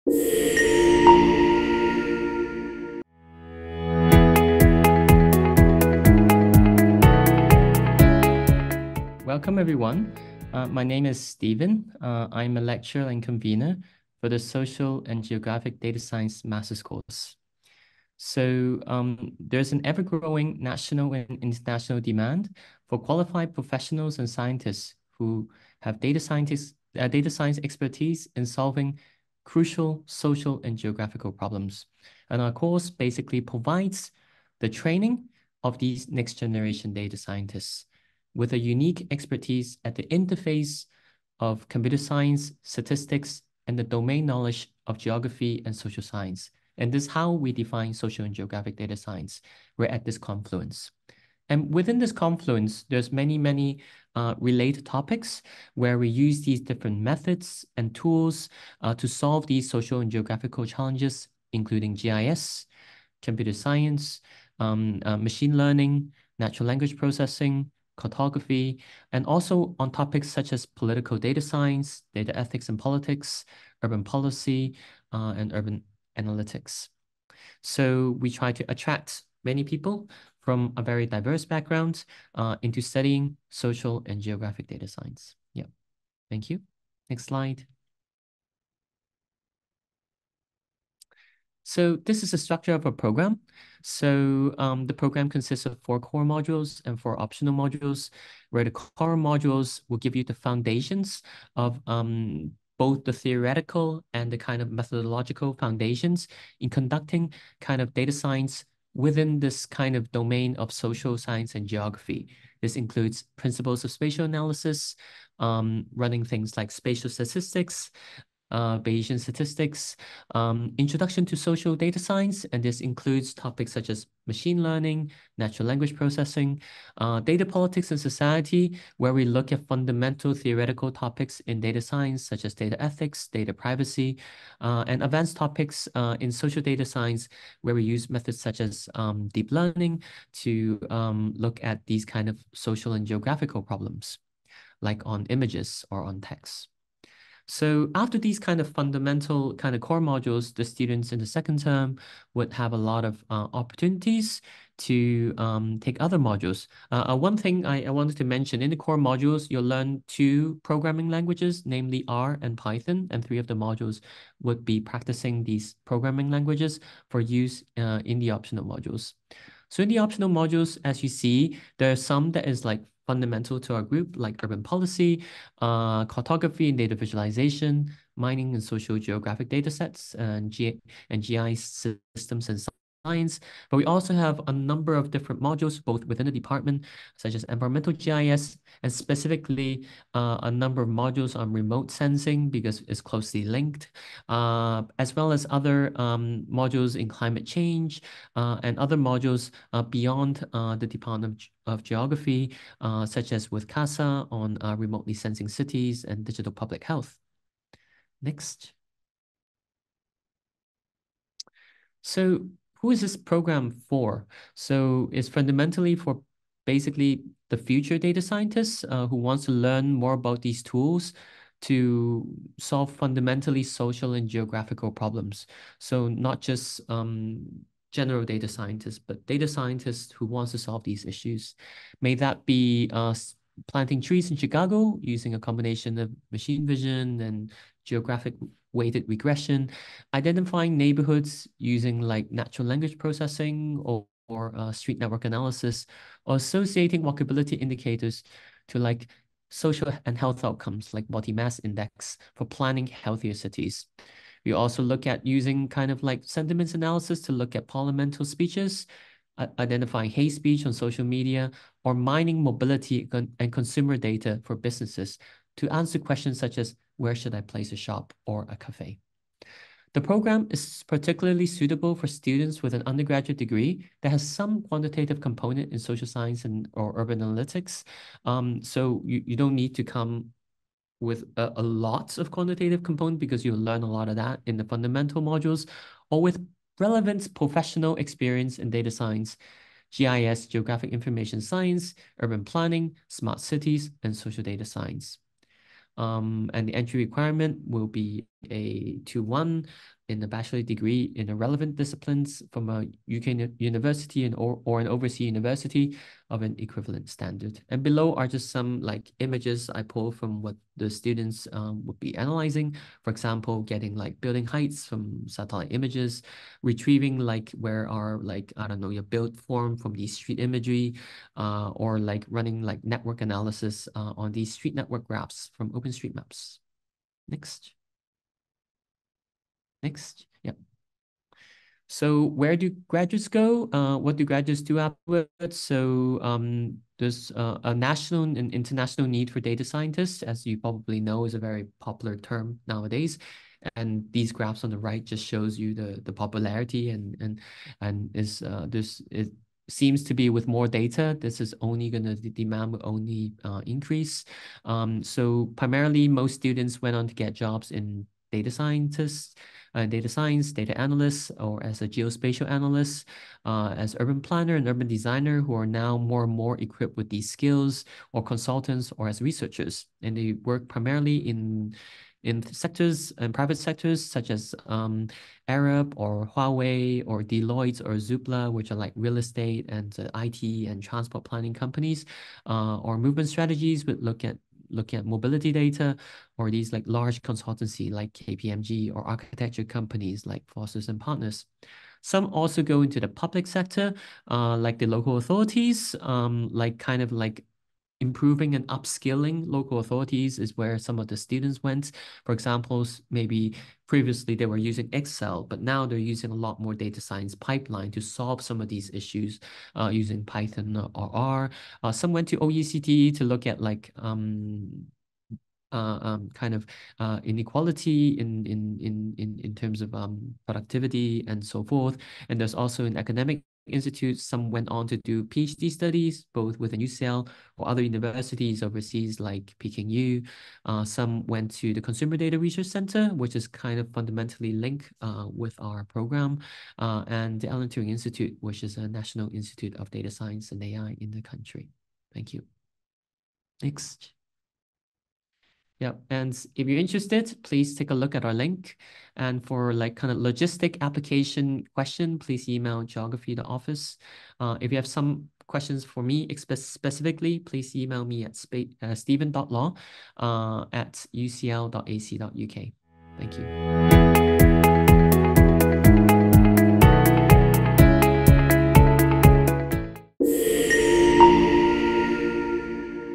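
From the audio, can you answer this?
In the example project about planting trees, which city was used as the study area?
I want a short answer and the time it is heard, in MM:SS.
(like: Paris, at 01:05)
Chicago, at 03:54.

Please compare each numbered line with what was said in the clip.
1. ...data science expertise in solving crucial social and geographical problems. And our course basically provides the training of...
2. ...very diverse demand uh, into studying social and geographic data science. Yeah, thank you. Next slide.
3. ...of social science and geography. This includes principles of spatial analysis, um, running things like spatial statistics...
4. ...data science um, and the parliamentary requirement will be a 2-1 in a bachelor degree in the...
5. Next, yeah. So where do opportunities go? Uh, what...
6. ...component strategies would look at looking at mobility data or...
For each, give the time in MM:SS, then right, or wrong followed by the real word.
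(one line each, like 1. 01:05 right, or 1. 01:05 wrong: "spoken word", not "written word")
1. 00:27 right
2. 01:20 wrong: "background", not "demand"
3. 01:50 right
4. 04:54 wrong: "entry", not "parliamentary"
5. 05:29 wrong: "graduates", not "opportunities"
6. 06:22 wrong: "movement", not "component".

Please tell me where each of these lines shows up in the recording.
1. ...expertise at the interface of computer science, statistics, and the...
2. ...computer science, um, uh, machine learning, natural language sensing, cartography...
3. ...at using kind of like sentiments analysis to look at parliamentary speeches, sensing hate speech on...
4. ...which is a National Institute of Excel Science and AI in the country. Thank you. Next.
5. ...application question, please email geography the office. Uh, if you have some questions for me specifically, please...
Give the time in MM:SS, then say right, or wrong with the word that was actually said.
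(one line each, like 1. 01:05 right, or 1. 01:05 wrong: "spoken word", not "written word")
1. 00:39 right
2. 01:03 wrong: "processing", not "sensing"
3. 04:15 wrong: "identifying", not "sensing"
4. 07:18 wrong: "Data", not "Excel"
5. 07:30 right.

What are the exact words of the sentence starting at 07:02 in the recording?
And there's also an academic Institute.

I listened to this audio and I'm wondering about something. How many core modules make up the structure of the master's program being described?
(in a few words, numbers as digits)
4.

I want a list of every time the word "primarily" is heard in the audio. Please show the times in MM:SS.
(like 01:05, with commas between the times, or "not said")
05:55, 06:10.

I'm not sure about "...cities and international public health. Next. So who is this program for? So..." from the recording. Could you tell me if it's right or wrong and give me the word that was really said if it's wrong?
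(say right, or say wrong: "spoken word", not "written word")
wrong: "digital", not "international".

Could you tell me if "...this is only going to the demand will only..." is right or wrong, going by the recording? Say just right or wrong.
right.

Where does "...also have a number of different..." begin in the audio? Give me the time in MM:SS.
03:03.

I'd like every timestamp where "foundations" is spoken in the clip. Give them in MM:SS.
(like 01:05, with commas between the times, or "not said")
01:40, 01:45.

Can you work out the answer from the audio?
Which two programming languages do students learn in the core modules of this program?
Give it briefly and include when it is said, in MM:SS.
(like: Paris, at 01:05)
R and Python, at 02:42.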